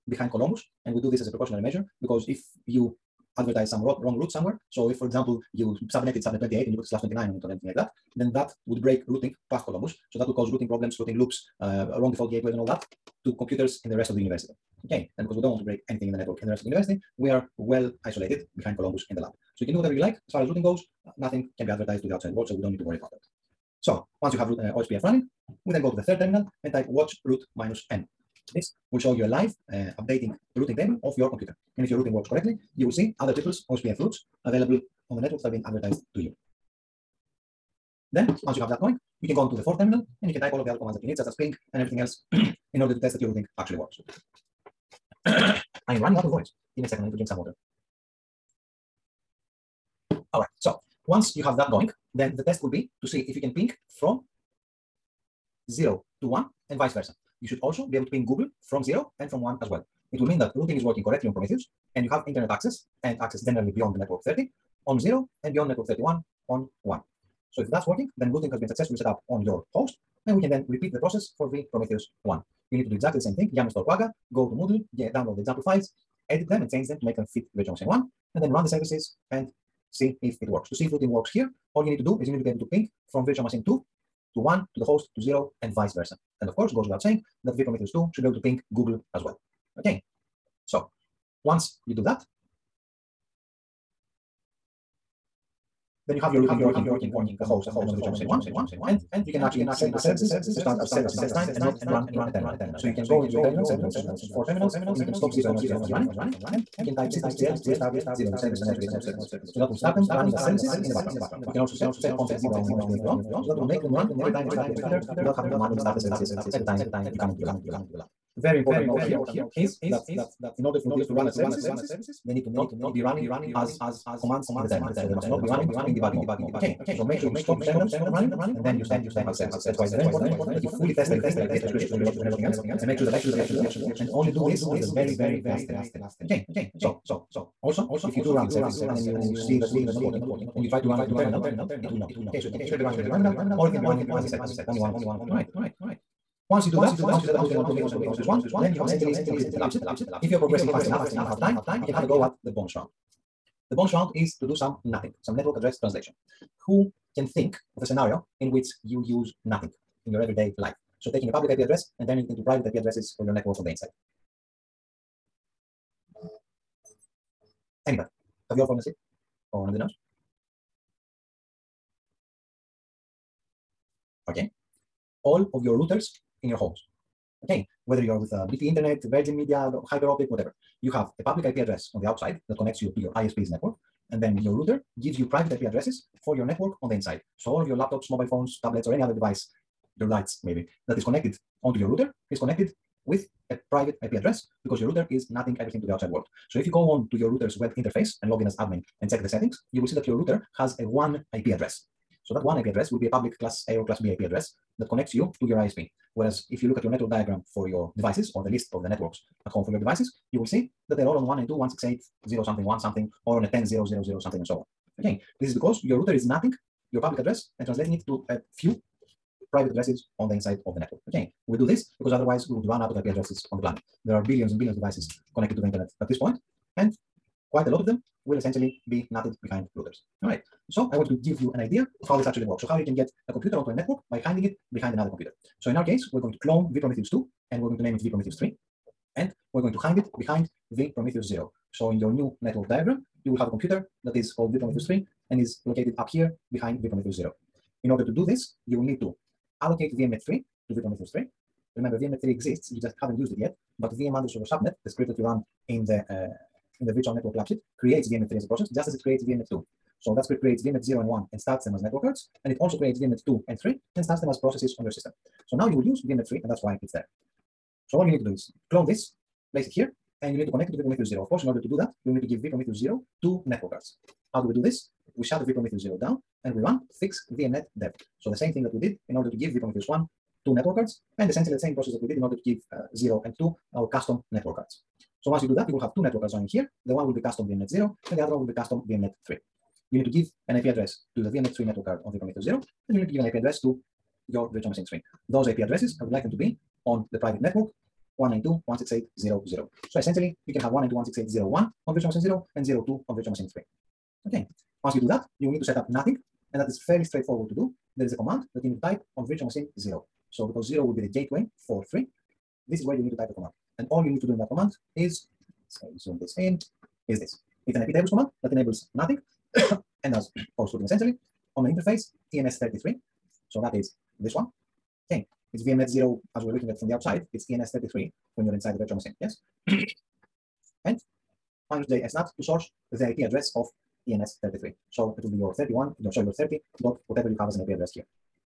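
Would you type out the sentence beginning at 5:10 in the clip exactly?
So because zero will be the gateway for three, this is where you need to type the command.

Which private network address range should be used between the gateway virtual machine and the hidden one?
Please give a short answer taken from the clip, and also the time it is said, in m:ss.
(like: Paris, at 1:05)
192.168.0.0, at 4:58.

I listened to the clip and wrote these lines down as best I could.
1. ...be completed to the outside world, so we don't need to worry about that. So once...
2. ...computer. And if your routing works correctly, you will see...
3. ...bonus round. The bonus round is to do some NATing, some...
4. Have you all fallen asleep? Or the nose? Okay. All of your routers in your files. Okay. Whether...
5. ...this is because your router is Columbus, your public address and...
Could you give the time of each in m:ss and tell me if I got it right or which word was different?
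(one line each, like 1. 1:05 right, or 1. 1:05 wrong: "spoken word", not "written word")
1. 0:21 wrong: "advertised", not "completed"
2. 0:31 right
3. 2:32 right
4. 2:48 wrong: "homes", not "files"
5. 3:35 wrong: "NATing", not "Columbus".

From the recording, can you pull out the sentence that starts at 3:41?
Okay, we do this because otherwise we would run out of IP addresses on the planet.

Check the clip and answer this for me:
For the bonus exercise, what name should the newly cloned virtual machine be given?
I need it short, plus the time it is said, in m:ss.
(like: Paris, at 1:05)
vPrometheus 3, at 3:58.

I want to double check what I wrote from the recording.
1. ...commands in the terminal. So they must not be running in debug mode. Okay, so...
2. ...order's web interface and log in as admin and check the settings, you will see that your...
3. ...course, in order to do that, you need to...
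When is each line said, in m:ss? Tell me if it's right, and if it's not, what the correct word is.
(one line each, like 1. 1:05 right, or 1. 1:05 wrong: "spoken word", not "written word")
1. 2:04 right
2. 3:17 wrong: "router", not "order"
3. 4:31 right.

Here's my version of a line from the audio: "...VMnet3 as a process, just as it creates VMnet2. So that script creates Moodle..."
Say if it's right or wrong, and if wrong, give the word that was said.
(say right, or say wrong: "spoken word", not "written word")
wrong: "VMnet", not "Moodle".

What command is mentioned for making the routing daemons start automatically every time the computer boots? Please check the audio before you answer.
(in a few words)
chkconfig.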